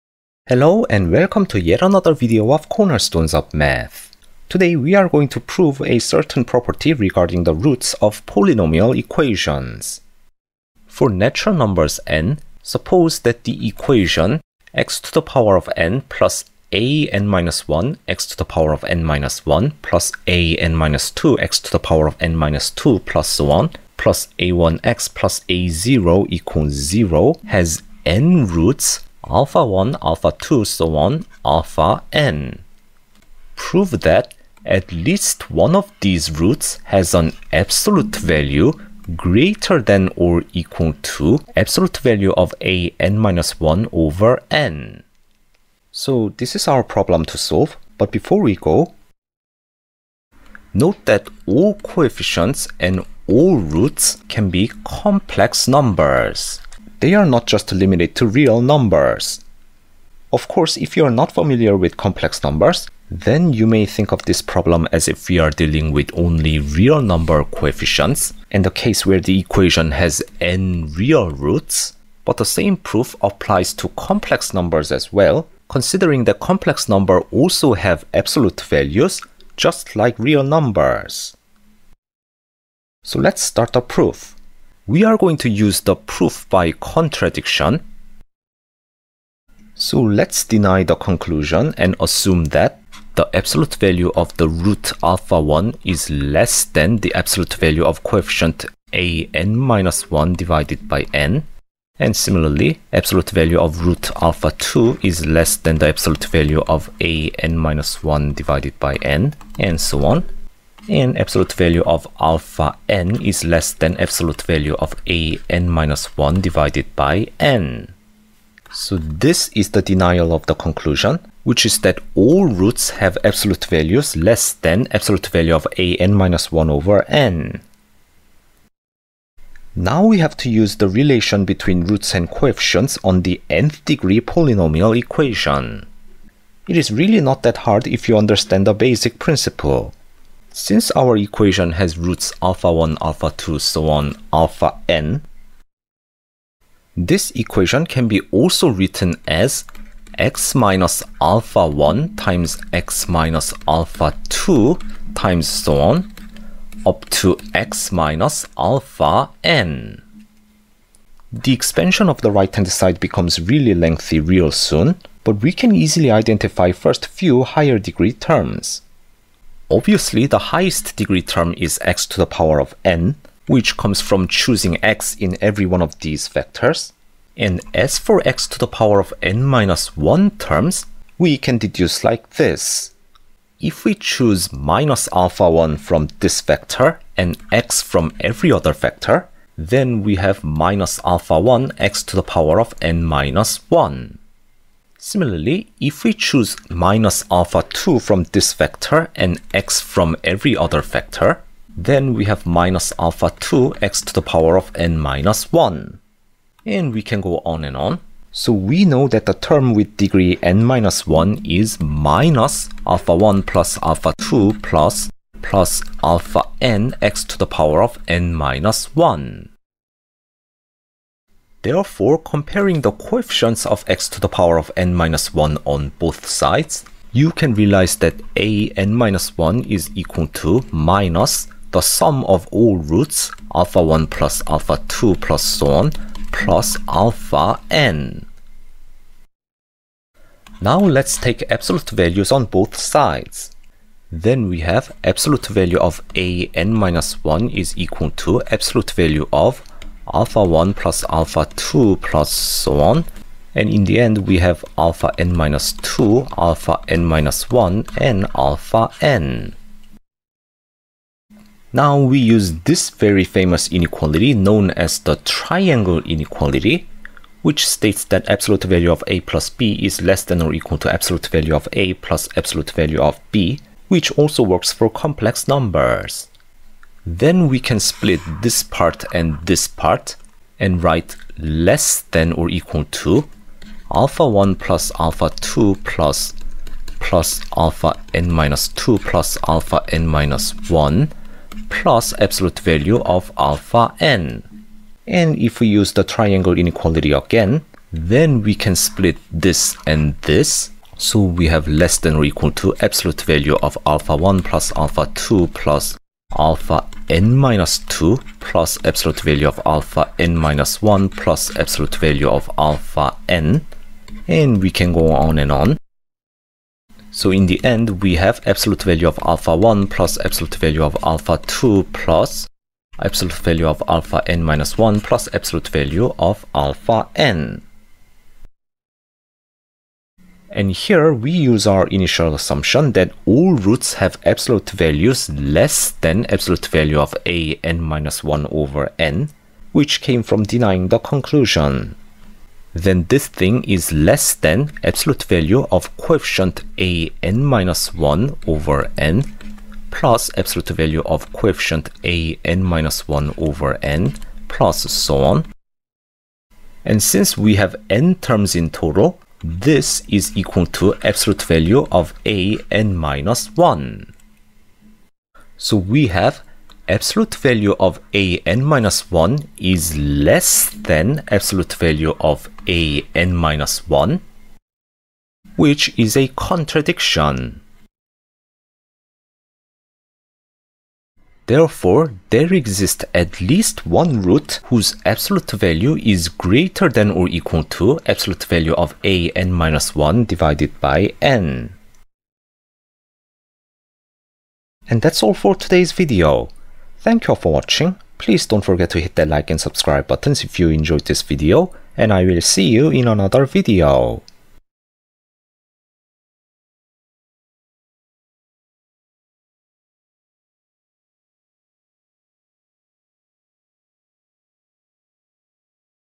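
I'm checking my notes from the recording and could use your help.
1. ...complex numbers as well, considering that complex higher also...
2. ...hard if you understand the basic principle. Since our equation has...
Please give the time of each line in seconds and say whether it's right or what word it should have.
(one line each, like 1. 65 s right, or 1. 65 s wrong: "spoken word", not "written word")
1. 74 s wrong: "number", not "higher"
2. 137 s right.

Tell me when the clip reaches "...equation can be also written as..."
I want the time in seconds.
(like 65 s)
147 s.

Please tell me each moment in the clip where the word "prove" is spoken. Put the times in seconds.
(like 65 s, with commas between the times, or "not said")
5 s, 33 s.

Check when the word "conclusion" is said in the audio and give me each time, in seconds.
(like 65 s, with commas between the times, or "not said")
90 s, 120 s, 340 s.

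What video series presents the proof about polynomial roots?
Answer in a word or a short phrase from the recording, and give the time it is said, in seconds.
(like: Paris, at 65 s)
Cornerstones of Math, at 2 s.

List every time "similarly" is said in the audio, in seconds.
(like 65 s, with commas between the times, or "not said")
102 s, 195 s.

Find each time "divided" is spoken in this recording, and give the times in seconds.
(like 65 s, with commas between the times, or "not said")
100 s, 108 s, 116 s, 390 s.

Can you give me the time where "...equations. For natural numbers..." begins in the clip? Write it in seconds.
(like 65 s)
8 s.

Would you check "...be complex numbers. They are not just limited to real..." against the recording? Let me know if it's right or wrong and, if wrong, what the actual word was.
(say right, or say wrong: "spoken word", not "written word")
right.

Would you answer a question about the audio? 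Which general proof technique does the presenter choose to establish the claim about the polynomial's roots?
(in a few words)
proof by contradiction.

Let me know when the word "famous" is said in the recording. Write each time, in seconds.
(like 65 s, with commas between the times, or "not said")
263 s.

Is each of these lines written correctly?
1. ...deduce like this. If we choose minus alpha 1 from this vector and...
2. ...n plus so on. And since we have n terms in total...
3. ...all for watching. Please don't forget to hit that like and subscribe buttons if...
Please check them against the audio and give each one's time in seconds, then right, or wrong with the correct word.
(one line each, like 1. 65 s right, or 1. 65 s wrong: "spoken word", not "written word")
1. 181 s right
2. 353 s right
3. 397 s right.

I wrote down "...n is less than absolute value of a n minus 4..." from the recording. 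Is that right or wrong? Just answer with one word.
wrong.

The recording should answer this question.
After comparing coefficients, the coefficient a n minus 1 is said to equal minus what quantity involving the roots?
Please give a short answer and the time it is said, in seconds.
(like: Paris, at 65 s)
the sum of all roots, at 231 s.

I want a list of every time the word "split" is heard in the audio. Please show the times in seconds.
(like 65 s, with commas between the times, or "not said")
277 s, 298 s.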